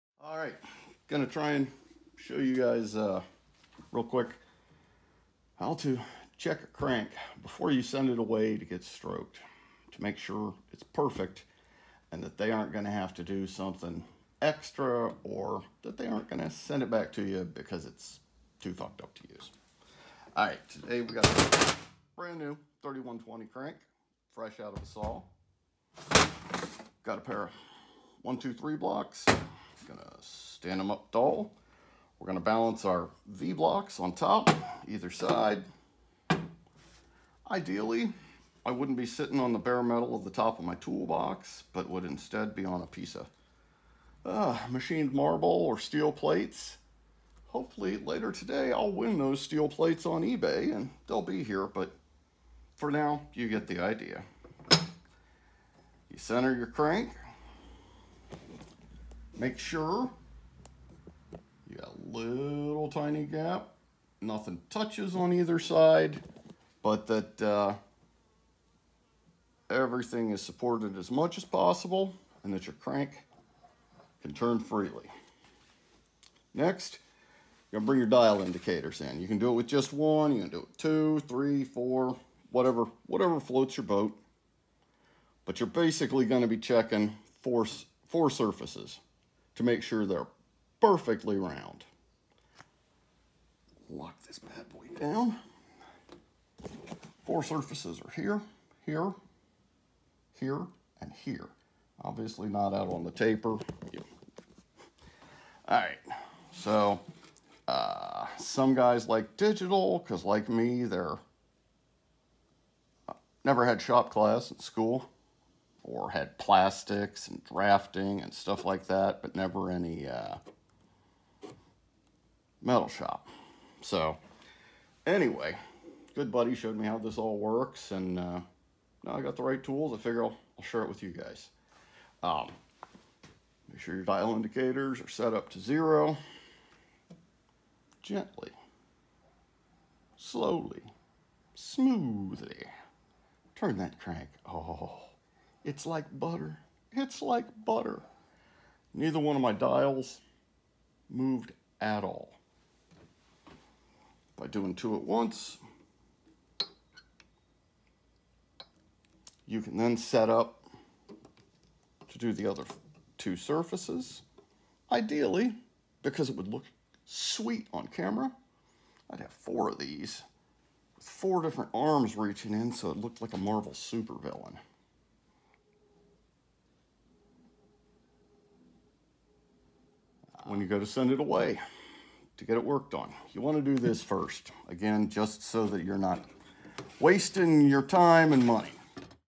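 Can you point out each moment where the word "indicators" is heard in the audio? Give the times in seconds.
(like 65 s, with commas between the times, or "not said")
78 s, 134 s.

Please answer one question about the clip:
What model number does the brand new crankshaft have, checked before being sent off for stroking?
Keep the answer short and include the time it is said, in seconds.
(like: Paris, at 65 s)
3120, at 22 s.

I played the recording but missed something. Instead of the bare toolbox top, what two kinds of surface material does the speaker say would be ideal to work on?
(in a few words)
machined marble or steel plates.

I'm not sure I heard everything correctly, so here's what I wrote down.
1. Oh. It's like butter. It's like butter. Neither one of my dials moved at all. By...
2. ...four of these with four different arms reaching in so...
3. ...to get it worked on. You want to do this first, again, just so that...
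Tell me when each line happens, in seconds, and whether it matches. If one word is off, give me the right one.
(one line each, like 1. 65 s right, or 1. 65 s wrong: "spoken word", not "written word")
1. 144 s right
2. 169 s right
3. 182 s right.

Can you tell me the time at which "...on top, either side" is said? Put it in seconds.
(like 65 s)
33 s.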